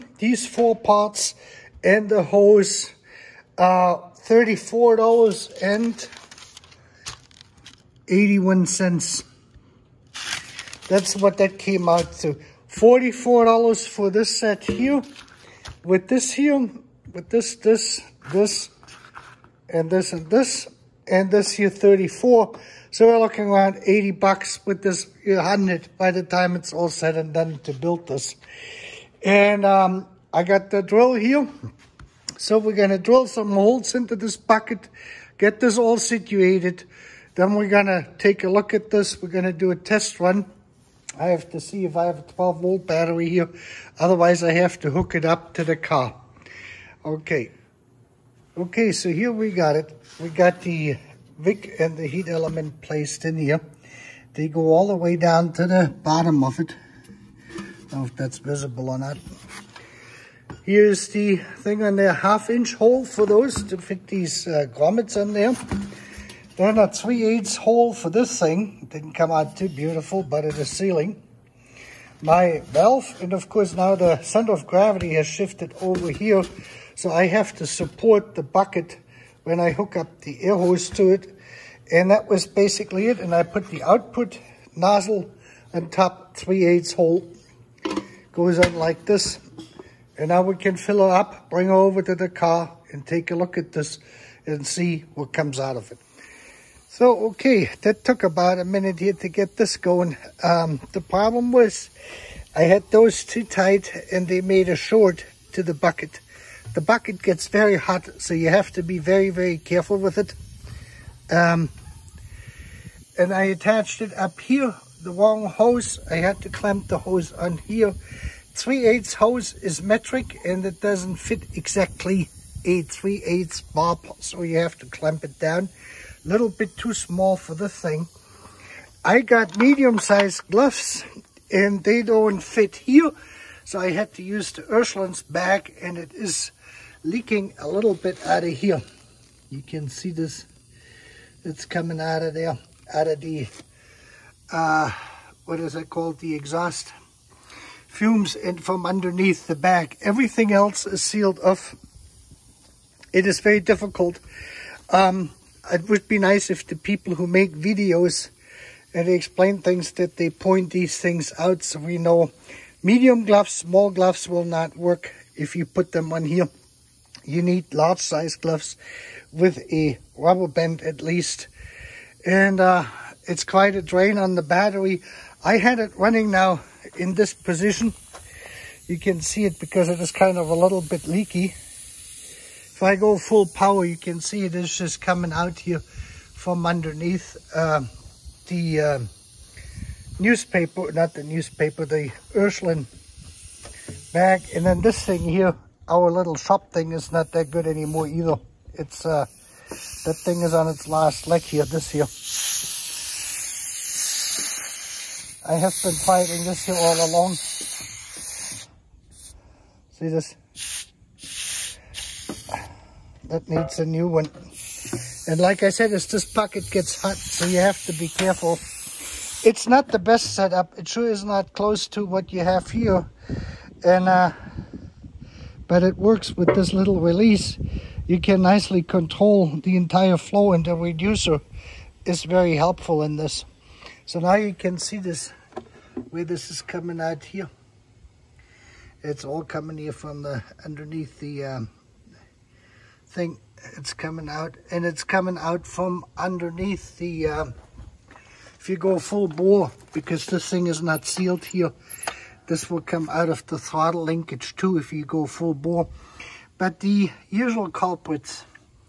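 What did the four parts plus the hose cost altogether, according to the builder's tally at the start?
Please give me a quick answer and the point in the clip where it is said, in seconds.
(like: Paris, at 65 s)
$34.81, at 4 s.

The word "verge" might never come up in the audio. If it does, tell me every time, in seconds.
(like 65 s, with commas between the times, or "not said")
not said.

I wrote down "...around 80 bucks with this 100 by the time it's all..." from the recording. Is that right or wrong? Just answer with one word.
right.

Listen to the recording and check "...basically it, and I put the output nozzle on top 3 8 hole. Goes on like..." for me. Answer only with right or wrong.
right.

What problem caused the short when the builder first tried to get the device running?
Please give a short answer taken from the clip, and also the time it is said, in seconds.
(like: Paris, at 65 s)
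too tight, at 103 s.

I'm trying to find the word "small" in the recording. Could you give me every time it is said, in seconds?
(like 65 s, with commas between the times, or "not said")
126 s, 163 s.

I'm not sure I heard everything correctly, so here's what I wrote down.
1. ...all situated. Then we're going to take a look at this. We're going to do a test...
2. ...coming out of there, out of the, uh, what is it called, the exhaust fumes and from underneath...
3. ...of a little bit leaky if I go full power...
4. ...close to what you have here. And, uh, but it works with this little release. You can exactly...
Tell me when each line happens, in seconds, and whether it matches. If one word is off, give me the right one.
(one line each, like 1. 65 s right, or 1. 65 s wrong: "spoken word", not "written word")
1. 35 s right
2. 141 s right
3. 180 s right
4. 221 s wrong: "nicely", not "exactly".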